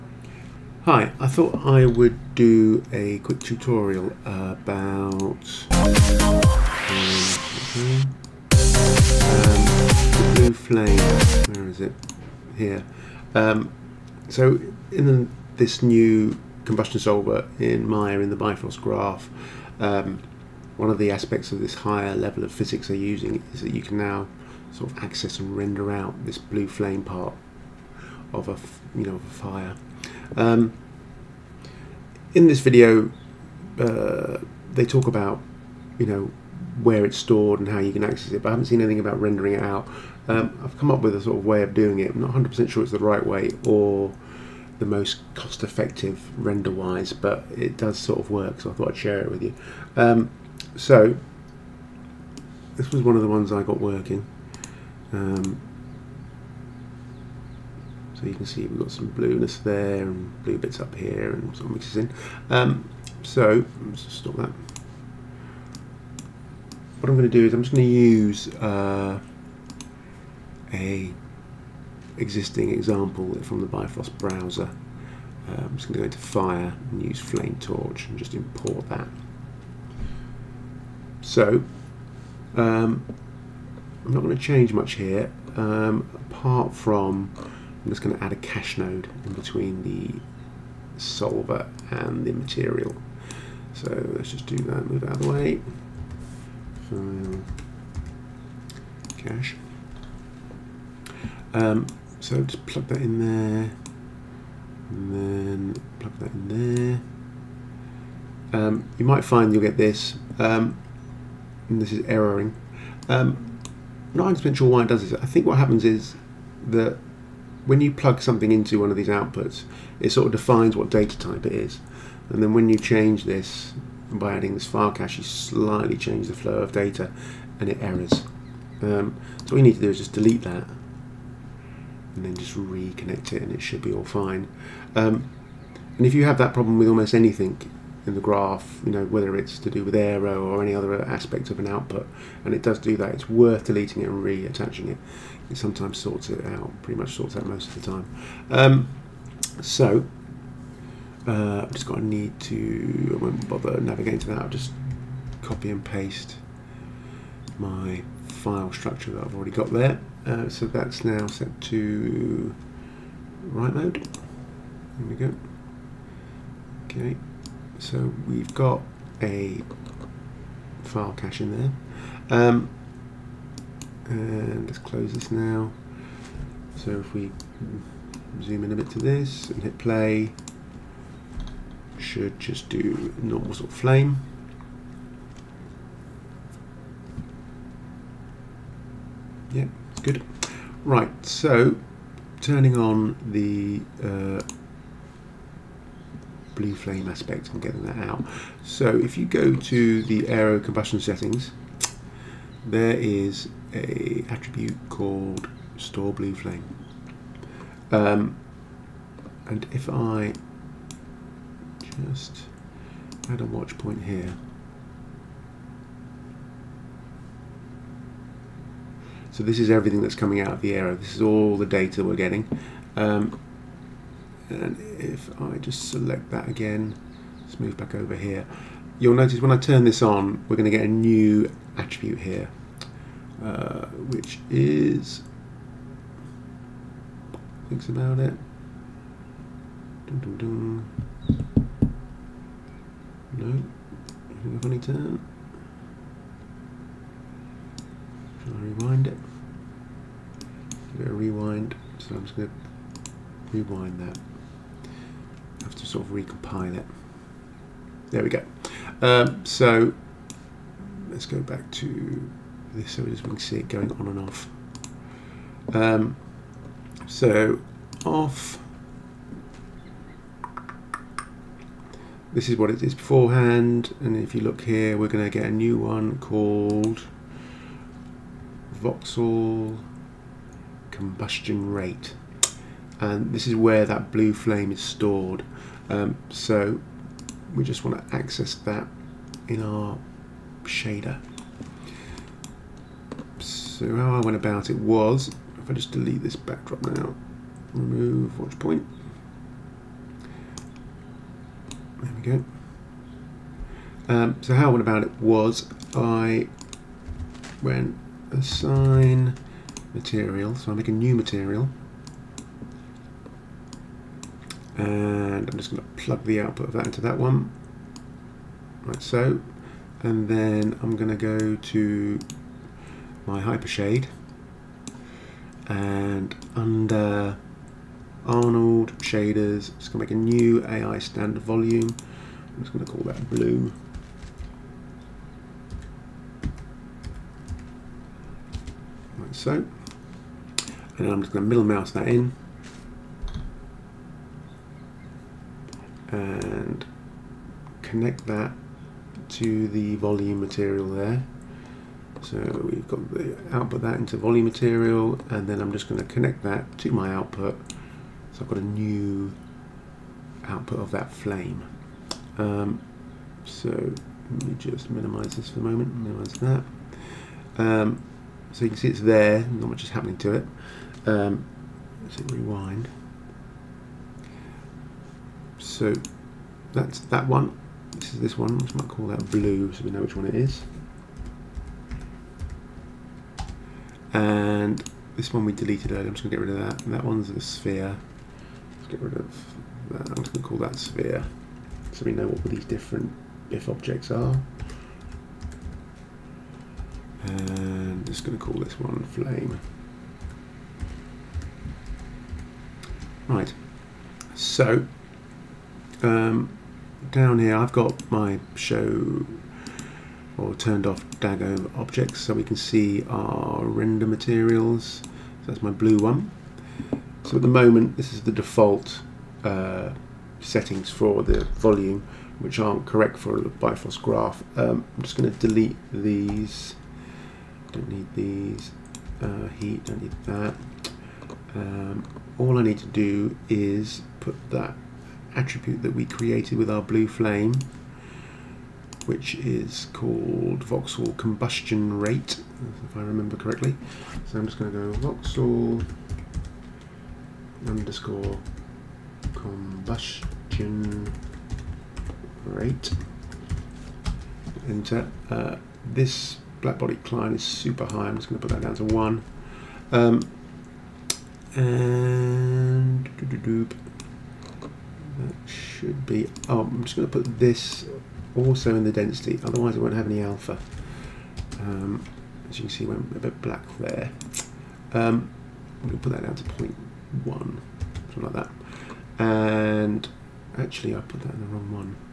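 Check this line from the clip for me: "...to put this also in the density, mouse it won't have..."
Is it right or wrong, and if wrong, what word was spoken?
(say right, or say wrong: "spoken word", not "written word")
wrong: "otherwise", not "mouse".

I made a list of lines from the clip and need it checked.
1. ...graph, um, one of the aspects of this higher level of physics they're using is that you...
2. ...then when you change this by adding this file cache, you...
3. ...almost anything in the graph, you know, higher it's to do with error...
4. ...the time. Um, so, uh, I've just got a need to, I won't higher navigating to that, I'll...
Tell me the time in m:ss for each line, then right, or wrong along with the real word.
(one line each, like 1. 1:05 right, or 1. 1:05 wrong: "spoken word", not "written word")
1. 0:18 right
2. 2:02 right
3. 2:16 wrong: "whether", not "higher"
4. 2:27 wrong: "bother", not "higher".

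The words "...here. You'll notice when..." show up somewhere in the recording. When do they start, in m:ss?
3:48.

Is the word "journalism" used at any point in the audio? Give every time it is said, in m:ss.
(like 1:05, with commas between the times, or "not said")
not said.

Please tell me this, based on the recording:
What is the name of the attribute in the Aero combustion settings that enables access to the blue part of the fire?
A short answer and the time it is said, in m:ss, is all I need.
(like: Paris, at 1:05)
store blue flame, at 3:25.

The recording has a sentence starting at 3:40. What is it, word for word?
This is all the data we're getting.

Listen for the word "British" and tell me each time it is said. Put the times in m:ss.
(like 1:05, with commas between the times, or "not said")
not said.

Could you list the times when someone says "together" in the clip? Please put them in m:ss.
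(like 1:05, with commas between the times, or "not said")
not said.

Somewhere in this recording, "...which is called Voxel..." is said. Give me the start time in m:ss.
7:19.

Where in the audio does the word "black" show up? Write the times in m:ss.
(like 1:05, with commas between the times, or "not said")
7:36, 7:53.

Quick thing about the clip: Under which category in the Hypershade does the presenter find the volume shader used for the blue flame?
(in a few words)
Arnold shaders.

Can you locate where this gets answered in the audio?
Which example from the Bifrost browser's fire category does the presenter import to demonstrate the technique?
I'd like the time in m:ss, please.
1:17.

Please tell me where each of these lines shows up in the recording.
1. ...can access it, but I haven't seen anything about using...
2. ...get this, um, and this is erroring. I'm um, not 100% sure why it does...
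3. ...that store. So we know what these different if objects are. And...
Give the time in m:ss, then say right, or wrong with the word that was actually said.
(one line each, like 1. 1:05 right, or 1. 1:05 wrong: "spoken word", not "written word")
1. 0:37 wrong: "rendering", not "using"
2. 1:49 right
3. 6:30 wrong: "sphere", not "store".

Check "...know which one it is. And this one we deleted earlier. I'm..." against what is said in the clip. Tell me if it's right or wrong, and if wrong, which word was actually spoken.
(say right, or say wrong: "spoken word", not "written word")
right.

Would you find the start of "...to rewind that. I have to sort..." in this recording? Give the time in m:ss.
4:12.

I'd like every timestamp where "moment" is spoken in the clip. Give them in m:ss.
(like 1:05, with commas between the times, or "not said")
6:05, 6:57.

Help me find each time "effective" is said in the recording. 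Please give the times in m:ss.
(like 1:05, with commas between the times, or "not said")
0:45.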